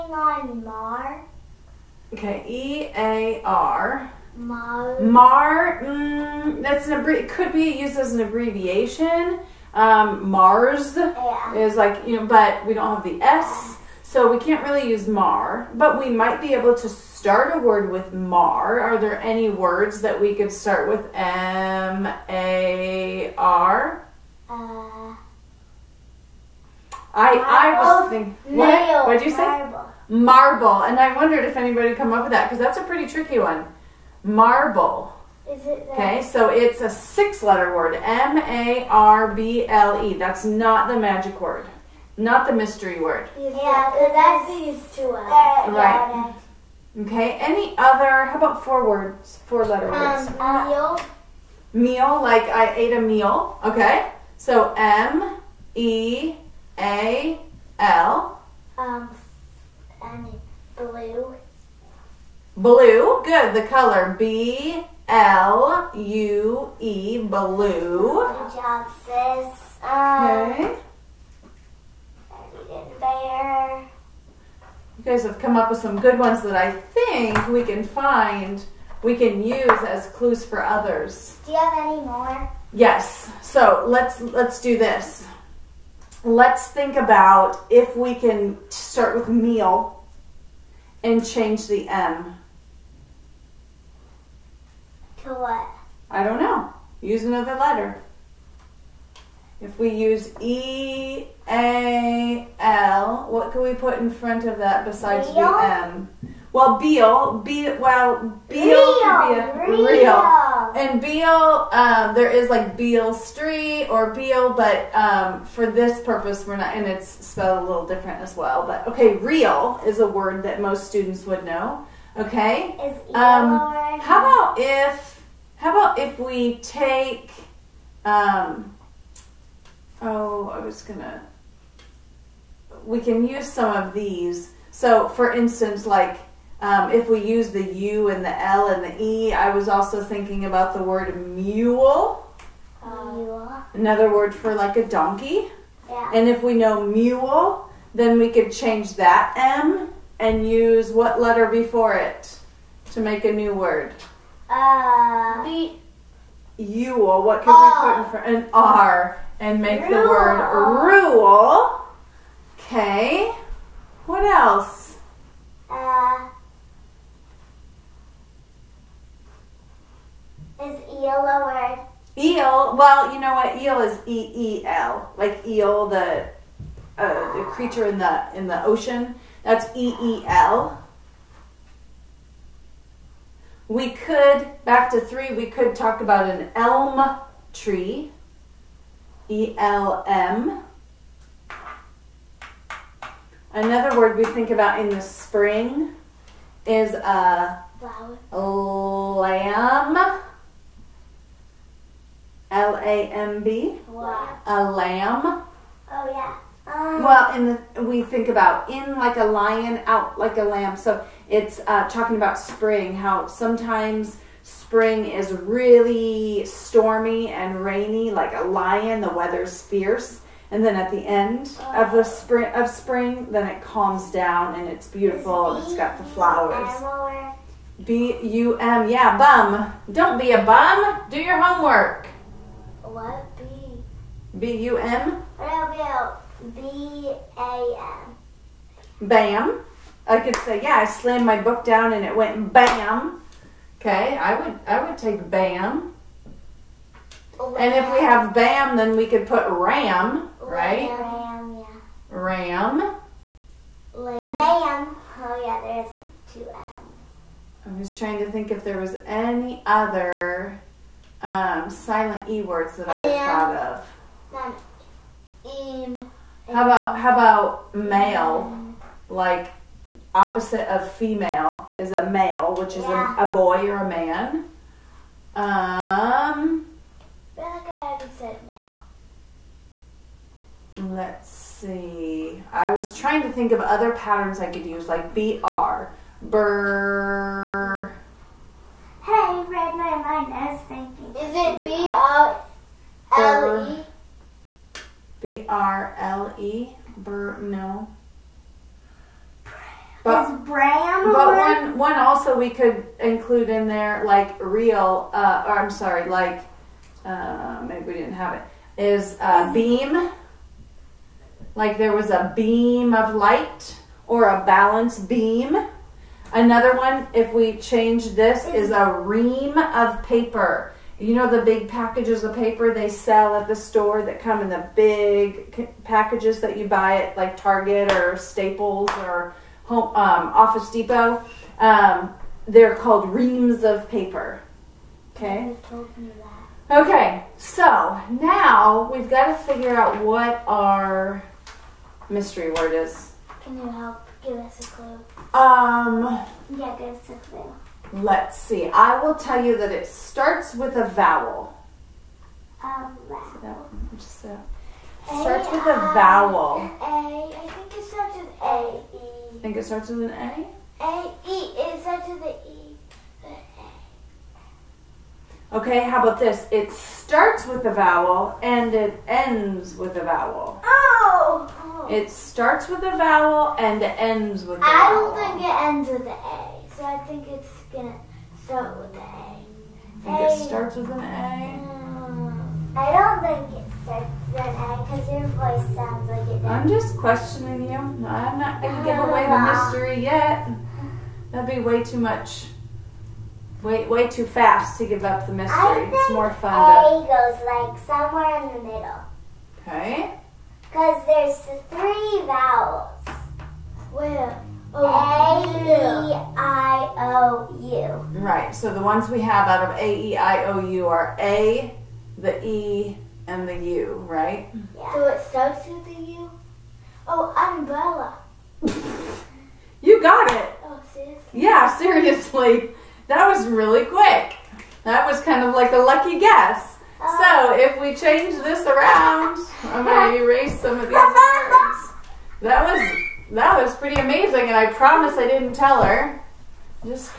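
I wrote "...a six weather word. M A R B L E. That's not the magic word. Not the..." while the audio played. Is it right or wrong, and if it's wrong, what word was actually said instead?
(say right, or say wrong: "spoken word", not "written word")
wrong: "letter", not "weather".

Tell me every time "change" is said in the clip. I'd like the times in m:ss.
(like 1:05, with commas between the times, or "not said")
1:31, 2:28, 5:17, 7:07.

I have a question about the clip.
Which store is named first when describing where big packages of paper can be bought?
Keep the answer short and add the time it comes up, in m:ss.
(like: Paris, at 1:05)
Target, at 5:27.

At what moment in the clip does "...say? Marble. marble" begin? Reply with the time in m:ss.
0:29.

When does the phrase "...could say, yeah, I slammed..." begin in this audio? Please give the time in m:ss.
4:00.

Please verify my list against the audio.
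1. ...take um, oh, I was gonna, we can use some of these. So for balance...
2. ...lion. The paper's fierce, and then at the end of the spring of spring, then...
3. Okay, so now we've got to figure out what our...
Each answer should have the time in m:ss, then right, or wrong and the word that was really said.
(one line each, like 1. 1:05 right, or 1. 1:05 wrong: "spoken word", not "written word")
1. 2:06 wrong: "instance", not "balance"
2. 3:38 wrong: "weather", not "paper"
3. 5:36 right.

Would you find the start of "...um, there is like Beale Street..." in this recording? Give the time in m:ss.
1:51.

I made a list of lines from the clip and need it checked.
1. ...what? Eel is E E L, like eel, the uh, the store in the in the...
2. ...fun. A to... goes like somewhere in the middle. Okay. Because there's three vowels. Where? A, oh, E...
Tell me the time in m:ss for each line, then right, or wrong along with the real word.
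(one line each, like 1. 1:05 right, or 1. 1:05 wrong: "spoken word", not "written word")
1. 2:53 wrong: "creature", not "store"
2. 6:36 right.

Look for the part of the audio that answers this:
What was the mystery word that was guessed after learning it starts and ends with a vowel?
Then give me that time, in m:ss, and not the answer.
6:57.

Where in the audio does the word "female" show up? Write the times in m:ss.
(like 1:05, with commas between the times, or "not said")
4:30.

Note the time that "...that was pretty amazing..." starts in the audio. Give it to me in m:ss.
7:13.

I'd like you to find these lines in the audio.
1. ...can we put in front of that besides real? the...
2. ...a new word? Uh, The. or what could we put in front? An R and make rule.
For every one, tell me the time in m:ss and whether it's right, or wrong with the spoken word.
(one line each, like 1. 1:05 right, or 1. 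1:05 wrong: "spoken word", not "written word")
1. 1:43 right
2. 2:33 right.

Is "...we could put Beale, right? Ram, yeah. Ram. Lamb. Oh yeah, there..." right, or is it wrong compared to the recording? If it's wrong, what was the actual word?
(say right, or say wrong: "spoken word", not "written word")
wrong: "Ram", not "Beale".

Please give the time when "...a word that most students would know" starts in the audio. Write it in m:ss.
1:59.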